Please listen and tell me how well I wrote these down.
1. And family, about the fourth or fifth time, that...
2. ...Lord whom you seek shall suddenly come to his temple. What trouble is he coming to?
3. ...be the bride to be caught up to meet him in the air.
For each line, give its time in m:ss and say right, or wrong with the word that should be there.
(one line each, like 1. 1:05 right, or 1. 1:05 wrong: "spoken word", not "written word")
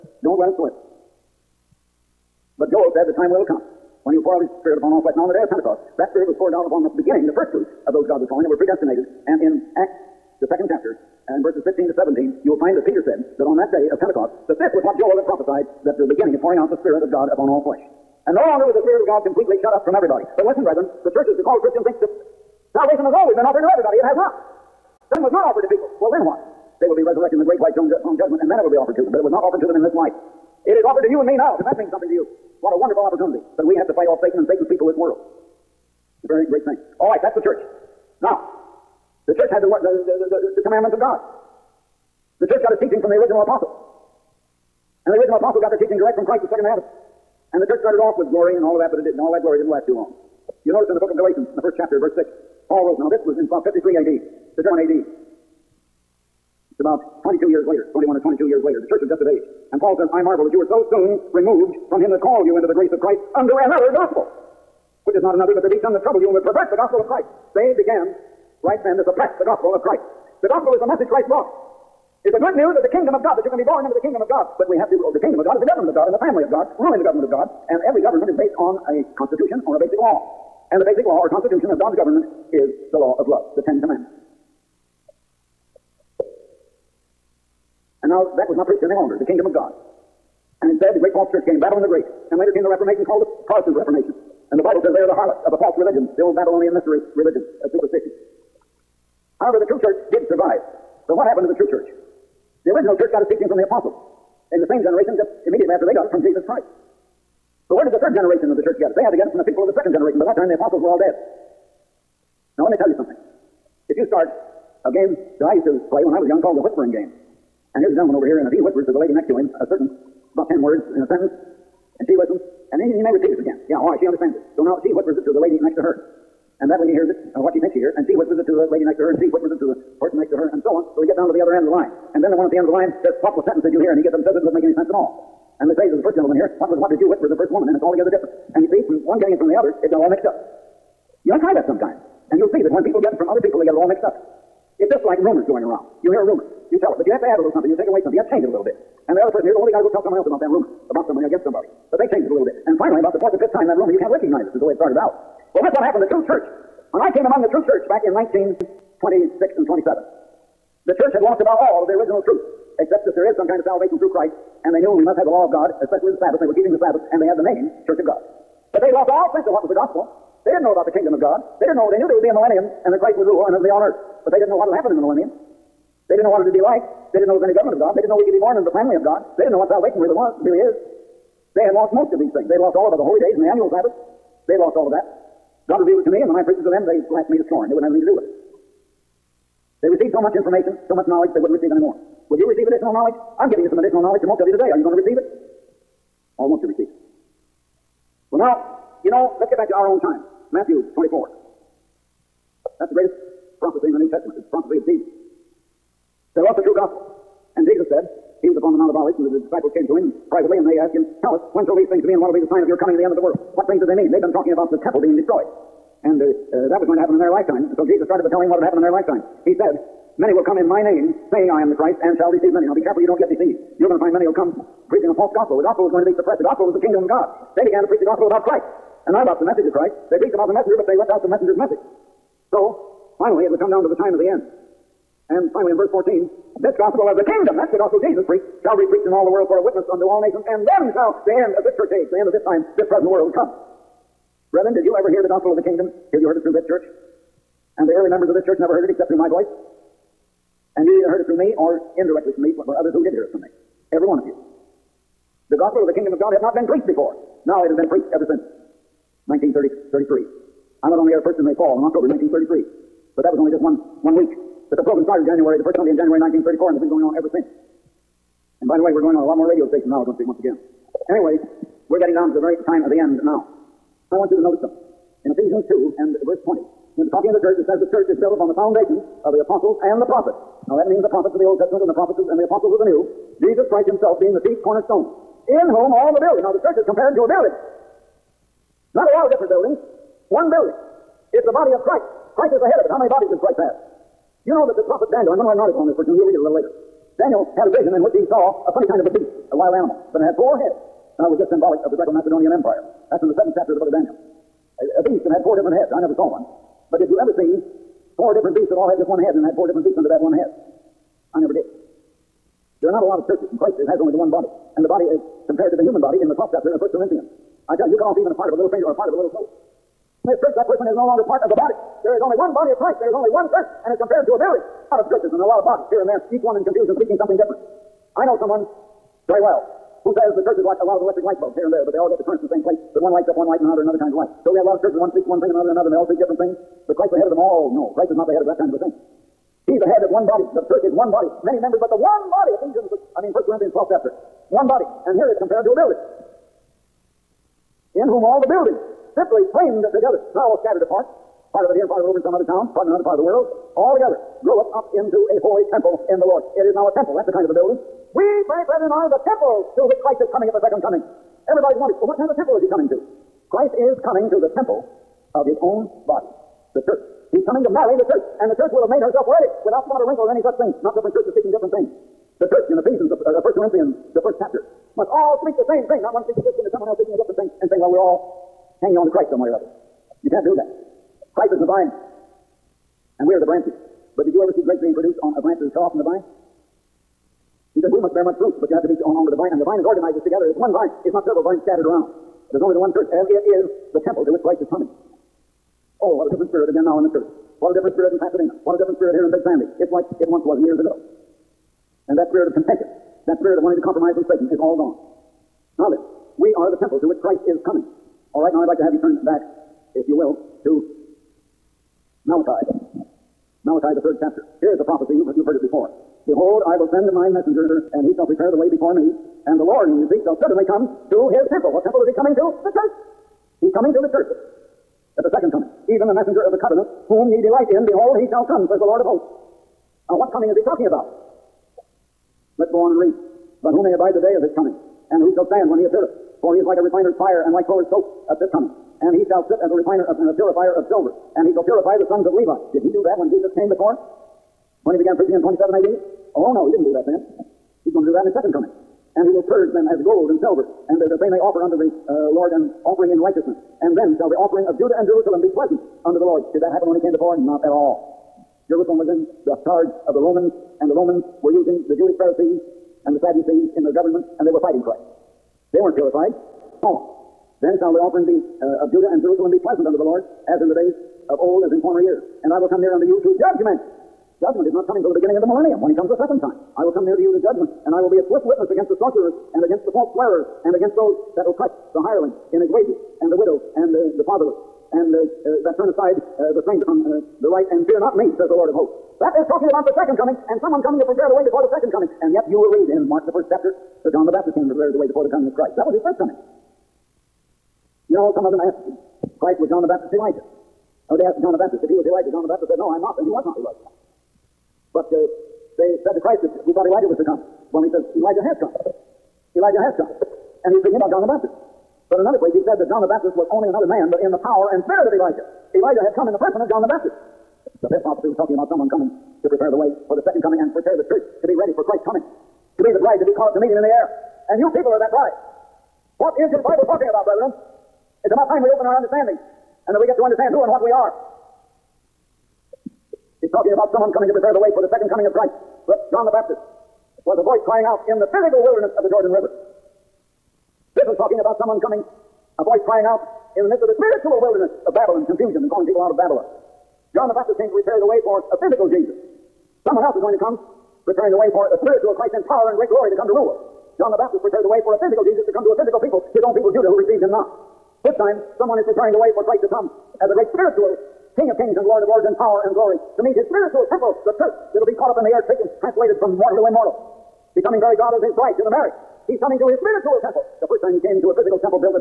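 1. 2:32 wrong: "finally", not "family"
2. 6:59 wrong: "temple", not "trouble"
3. 8:42 right.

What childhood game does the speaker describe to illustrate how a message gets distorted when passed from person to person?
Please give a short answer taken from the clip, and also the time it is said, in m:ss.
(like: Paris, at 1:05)
the whispering game, at 1:56.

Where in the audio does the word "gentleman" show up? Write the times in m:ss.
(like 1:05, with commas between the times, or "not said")
1:57, 2:16.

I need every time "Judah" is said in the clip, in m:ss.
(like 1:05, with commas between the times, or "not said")
7:34, 7:48, 9:16.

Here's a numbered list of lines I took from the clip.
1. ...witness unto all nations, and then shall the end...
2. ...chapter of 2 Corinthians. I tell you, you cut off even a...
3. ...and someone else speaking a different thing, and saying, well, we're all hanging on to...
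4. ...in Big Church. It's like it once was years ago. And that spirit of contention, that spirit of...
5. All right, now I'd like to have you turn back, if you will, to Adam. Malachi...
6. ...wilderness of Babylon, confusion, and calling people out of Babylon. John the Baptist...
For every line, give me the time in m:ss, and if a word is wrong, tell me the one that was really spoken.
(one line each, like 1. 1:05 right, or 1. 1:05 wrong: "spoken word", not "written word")
1. 3:59 right
2. 5:16 wrong: "1", not "2"
3. 6:16 right
4. 6:39 wrong: "Sandy", not "Church"
5. 6:48 wrong: "Malachi", not "Adam"
6. 9:04 right.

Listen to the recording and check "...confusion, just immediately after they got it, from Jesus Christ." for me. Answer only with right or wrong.
wrong.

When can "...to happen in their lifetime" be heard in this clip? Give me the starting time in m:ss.
3:36.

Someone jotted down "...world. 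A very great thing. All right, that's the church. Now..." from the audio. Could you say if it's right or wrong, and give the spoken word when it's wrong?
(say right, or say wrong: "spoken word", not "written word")
right.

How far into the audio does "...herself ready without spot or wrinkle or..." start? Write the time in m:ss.
6:09.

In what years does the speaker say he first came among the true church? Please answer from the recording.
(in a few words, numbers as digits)
1926 and 27.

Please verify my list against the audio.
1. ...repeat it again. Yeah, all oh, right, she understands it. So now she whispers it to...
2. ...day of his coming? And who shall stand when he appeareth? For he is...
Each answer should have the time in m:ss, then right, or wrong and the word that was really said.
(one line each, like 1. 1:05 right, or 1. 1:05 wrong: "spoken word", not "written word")
1. 2:03 right
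2. 7:14 right.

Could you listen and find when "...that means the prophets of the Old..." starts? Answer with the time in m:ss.
4:40.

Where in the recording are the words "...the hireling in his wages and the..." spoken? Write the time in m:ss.
8:01.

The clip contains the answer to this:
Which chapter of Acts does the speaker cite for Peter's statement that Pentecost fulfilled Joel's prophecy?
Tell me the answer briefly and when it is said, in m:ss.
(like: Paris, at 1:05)
second chapter, at 0:10.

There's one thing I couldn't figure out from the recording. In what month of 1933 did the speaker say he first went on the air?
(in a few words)
October.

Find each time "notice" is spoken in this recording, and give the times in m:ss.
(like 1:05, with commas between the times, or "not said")
0:50, 4:34.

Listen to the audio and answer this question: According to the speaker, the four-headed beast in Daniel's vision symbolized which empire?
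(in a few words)
Greco-Macedonian Empire.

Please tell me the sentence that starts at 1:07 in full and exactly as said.
They began right then to suppress the gospel of Christ.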